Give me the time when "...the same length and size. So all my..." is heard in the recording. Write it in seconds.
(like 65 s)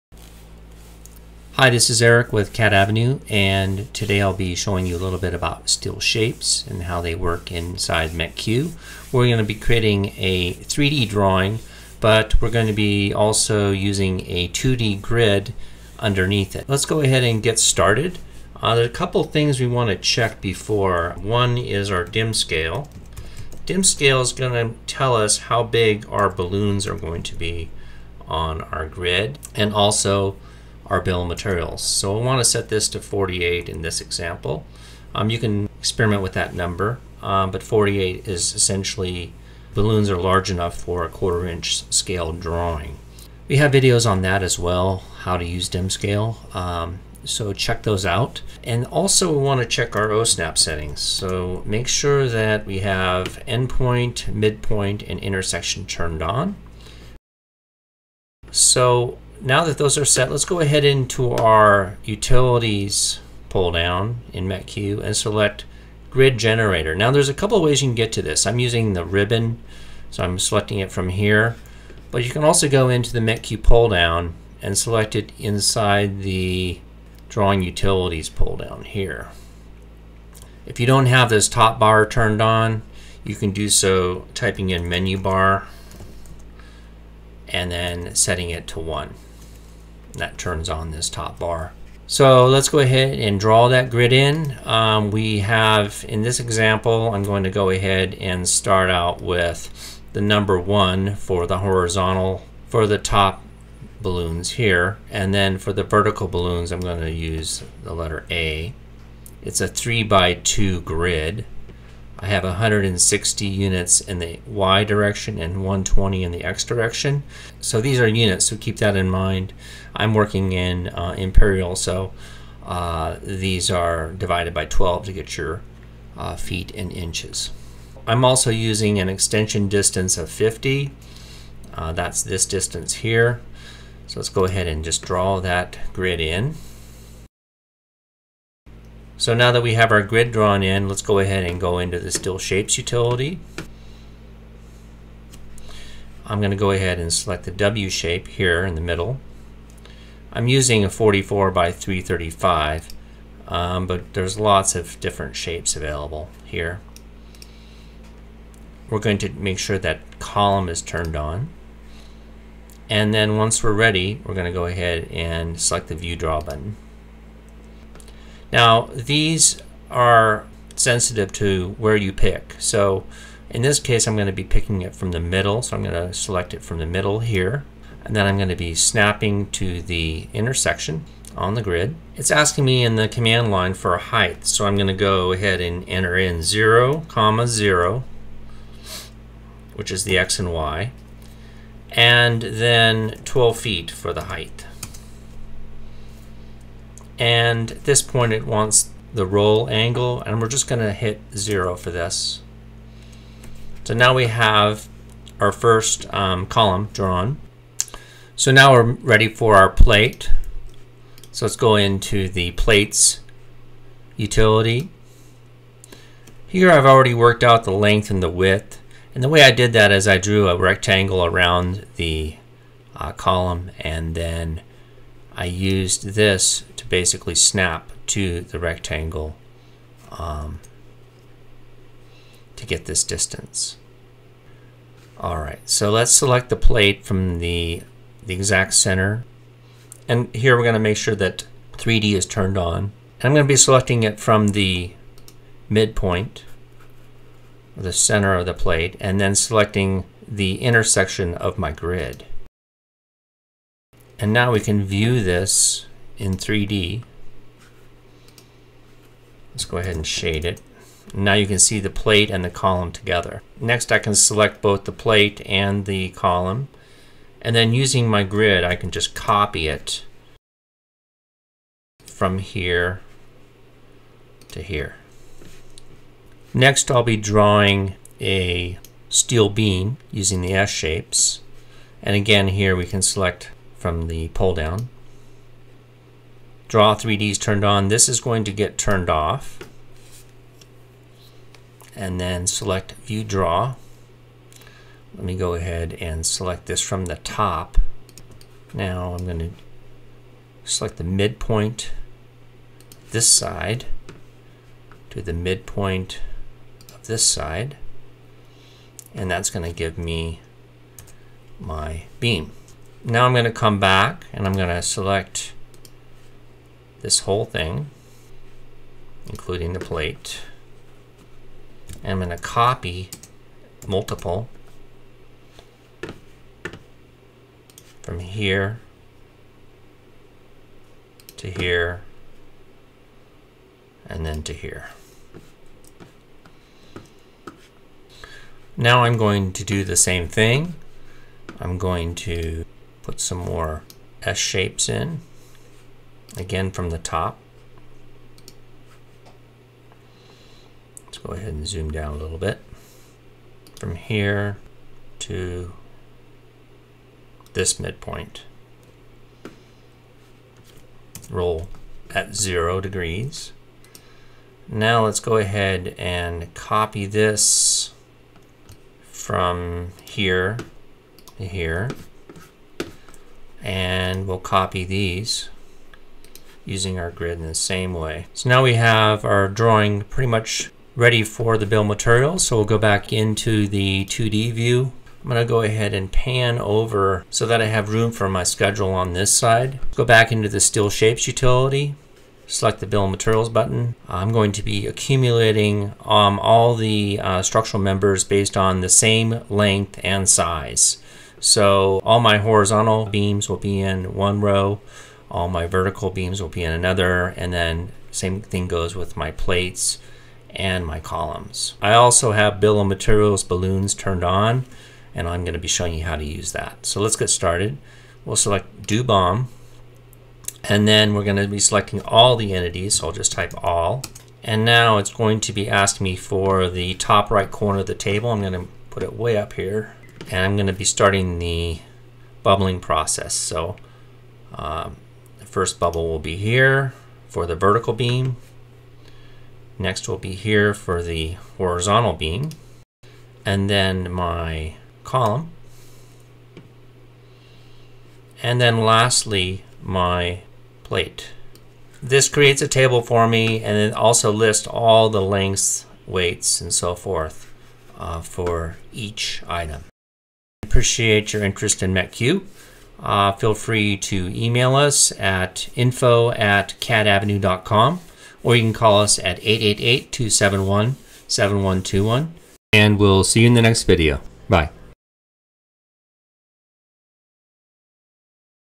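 398 s.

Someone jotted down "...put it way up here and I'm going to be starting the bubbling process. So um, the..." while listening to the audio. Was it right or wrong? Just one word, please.
right.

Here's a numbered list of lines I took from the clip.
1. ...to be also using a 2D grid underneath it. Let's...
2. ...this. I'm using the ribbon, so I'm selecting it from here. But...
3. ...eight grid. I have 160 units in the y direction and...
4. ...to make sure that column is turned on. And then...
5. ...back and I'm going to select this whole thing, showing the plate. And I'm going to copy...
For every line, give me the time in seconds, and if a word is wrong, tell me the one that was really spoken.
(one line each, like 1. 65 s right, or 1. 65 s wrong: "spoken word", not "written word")
1. 12 s right
2. 68 s right
3. 110 s wrong: "two", not "eight"
4. 159 s right
5. 313 s wrong: "including", not "showing".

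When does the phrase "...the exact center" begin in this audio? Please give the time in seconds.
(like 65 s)
238 s.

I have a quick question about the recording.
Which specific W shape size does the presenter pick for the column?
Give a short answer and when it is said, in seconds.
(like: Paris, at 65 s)
44 by 335, at 150 s.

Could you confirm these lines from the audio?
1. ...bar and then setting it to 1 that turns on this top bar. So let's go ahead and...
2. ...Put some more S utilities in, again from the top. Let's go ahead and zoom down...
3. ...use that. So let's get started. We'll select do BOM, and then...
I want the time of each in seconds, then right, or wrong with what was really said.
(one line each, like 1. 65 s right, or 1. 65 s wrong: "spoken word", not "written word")
1. 85 s right
2. 343 s wrong: "shapes", not "utilities"
3. 416 s right.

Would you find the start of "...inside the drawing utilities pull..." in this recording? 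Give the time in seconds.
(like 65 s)
75 s.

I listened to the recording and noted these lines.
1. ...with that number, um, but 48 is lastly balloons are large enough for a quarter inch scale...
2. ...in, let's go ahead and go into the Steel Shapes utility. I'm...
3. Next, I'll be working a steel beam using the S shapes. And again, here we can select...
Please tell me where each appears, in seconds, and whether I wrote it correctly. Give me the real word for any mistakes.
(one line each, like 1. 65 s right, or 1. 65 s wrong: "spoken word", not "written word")
1. 36 s wrong: "essentially", not "lastly"
2. 140 s right
3. 276 s wrong: "drawing", not "working".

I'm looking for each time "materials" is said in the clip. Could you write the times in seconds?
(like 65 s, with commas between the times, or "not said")
31 s, 381 s, 393 s, 412 s.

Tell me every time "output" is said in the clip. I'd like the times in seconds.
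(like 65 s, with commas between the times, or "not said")
not said.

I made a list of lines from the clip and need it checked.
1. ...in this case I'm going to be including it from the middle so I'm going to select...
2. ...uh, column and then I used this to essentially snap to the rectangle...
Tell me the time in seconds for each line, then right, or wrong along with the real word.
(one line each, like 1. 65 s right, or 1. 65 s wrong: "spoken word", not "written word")
1. 173 s wrong: "picking", not "including"
2. 222 s wrong: "basically", not "essentially".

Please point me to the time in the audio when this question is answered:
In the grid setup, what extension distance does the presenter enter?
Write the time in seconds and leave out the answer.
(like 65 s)
130 s.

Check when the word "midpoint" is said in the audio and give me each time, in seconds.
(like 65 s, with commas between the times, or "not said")
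54 s, 245 s, 301 s, 305 s, 357 s.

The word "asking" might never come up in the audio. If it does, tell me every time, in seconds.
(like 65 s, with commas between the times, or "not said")
182 s, 425 s.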